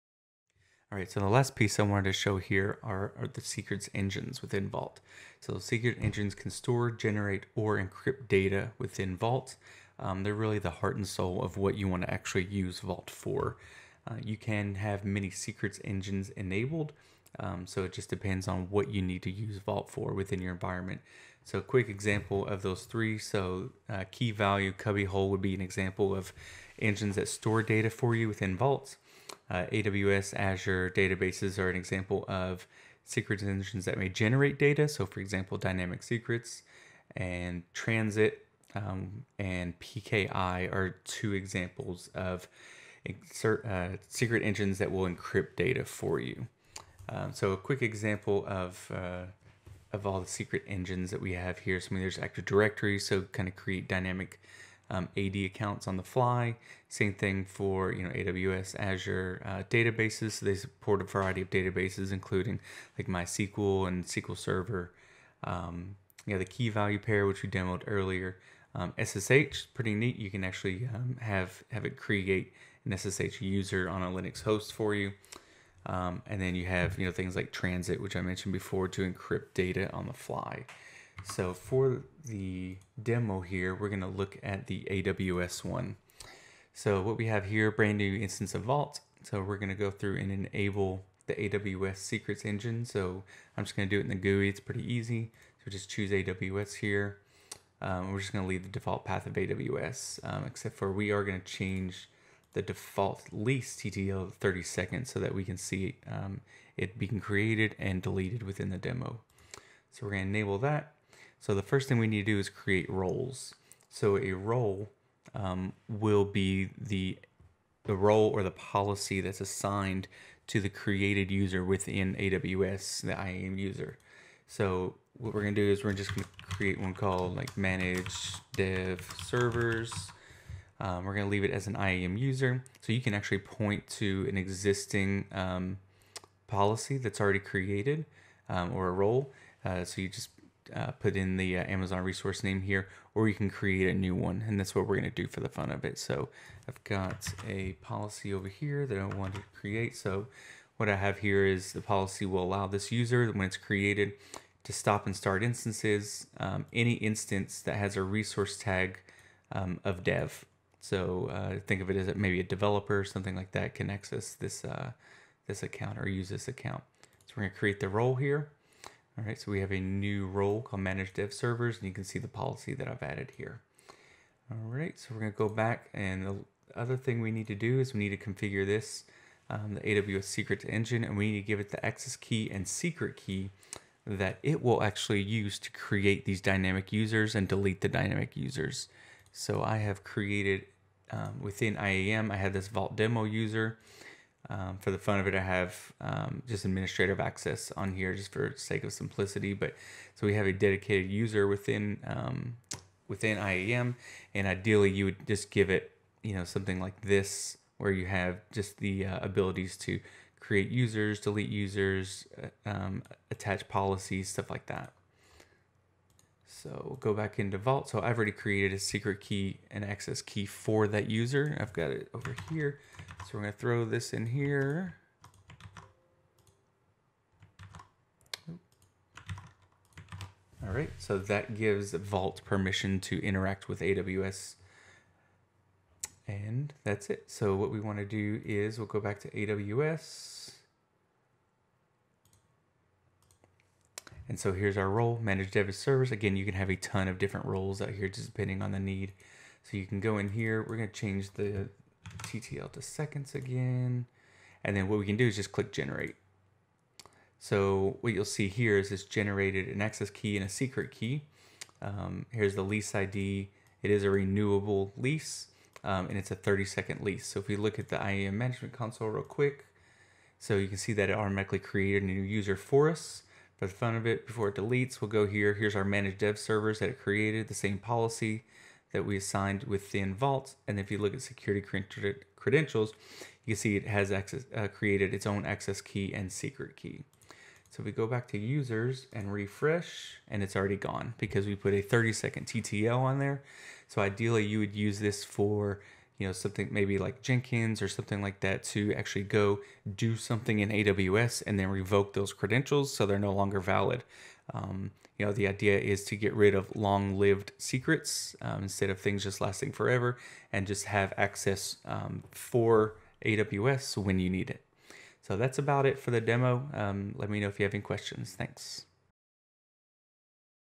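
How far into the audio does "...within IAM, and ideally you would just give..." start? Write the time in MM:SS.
03:23.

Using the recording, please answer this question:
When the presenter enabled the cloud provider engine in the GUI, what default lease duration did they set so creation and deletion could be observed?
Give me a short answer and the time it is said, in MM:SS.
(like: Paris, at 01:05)
30 seconds, at 01:44.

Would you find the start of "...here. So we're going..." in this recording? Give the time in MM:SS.
03:42.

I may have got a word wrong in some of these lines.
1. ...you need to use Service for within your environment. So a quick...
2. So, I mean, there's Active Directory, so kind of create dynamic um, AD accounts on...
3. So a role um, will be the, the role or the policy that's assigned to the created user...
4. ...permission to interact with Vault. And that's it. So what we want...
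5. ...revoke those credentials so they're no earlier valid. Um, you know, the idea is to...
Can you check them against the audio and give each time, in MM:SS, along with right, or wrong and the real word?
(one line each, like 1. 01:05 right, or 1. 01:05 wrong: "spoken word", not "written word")
1. 00:18 wrong: "Vault", not "Service"
2. 00:51 right
3. 01:53 right
4. 03:52 wrong: "AWS", not "Vault"
5. 05:01 wrong: "longer", not "earlier".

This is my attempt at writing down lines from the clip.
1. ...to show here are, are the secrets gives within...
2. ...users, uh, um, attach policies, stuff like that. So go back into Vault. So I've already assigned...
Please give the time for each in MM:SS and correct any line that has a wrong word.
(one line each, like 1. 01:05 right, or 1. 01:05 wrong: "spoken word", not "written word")
1. 00:02 wrong: "engines", not "gives"
2. 03:31 wrong: "created", not "assigned".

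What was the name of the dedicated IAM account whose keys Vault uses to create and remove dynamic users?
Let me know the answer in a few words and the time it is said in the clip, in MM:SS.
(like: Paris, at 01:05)
Vault demo user, at 03:12.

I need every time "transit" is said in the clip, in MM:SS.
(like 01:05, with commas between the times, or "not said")
00:37, 01:17.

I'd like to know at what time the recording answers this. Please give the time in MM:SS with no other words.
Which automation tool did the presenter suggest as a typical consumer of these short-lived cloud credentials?
04:57.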